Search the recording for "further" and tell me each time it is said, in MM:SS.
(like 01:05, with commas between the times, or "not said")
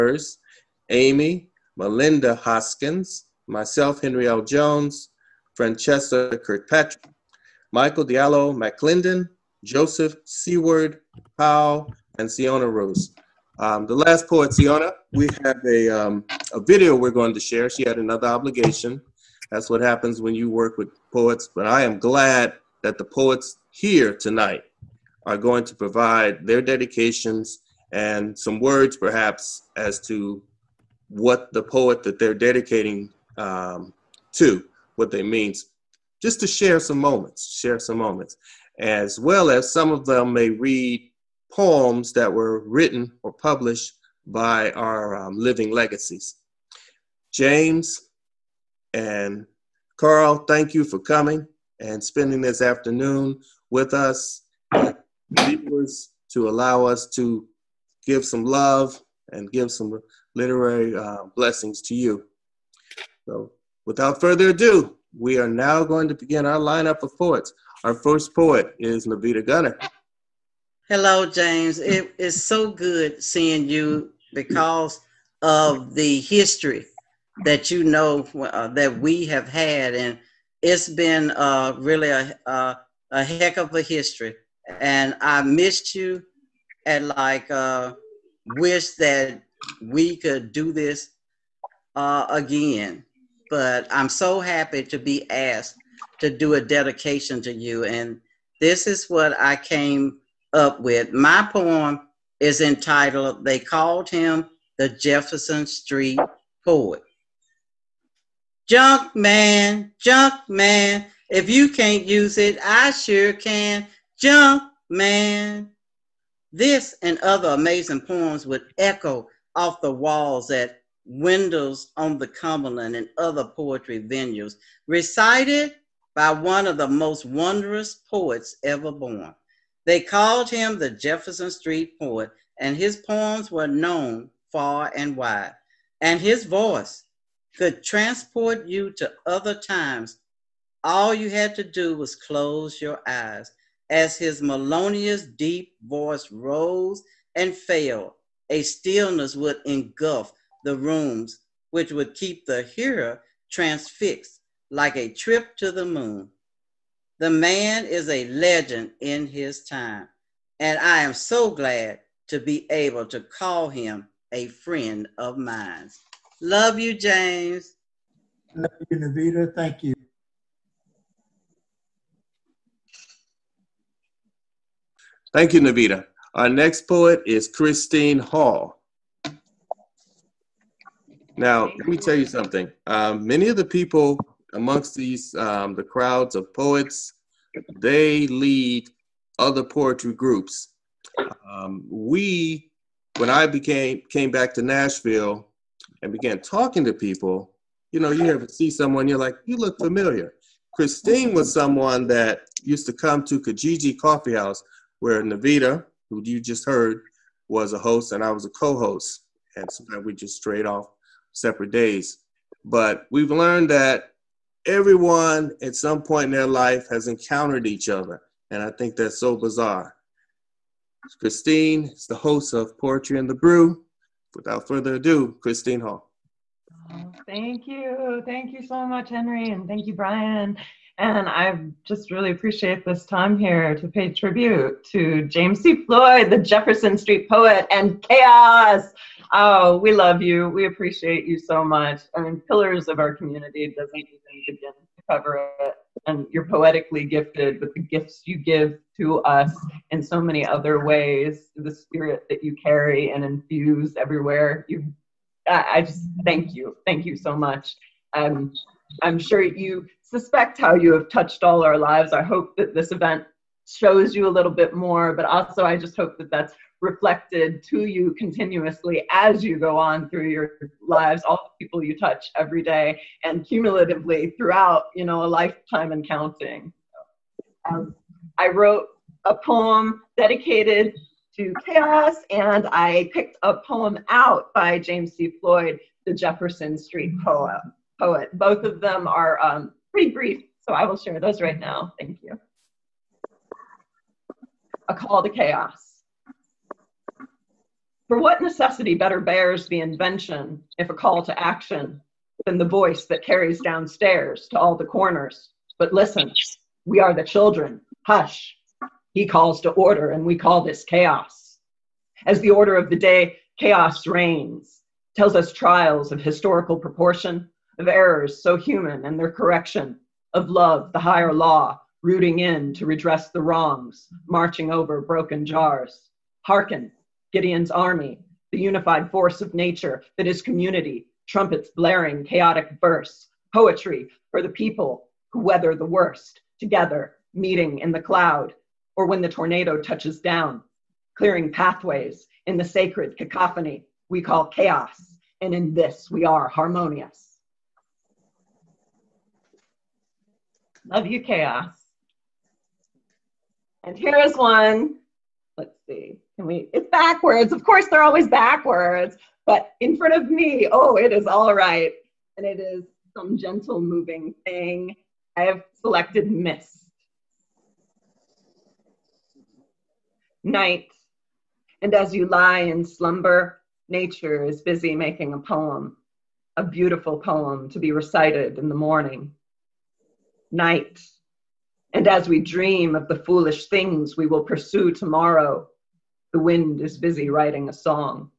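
01:04, 03:44.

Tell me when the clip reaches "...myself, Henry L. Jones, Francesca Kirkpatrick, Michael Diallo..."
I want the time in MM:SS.
00:03.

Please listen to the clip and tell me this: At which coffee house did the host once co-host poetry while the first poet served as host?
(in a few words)
Kijiji Coffee House.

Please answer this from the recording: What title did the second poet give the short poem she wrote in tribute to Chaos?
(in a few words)
A Call to Chaos.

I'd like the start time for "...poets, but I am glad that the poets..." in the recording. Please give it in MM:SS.
00:21.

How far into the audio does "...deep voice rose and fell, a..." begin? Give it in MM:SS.
02:25.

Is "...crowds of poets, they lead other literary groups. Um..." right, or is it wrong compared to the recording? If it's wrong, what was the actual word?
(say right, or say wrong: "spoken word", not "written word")
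wrong: "poetry", not "literary".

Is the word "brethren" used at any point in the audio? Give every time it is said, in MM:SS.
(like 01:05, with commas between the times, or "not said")
not said.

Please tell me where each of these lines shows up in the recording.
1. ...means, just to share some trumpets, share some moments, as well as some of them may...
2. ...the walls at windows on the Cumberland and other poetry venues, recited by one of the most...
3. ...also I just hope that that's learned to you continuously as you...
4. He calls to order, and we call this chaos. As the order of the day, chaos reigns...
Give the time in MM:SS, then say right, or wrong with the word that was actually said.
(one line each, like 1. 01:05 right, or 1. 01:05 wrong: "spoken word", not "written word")
1. 00:35 wrong: "moments", not "trumpets"
2. 01:59 right
3. 04:25 wrong: "reflected", not "learned"
4. 05:09 right.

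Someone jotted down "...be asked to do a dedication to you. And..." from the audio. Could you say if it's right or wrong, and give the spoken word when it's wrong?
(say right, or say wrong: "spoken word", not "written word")
right.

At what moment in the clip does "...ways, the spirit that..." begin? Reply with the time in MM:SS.
04:10.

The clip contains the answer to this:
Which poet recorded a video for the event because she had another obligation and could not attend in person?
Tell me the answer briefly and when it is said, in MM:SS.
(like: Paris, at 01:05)
Siona Rose, at 00:12.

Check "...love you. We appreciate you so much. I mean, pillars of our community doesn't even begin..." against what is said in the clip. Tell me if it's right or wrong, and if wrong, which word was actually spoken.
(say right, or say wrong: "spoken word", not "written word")
right.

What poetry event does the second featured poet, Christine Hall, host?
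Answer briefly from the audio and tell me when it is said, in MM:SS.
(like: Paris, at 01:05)
Poetry and the Brew, at 03:42.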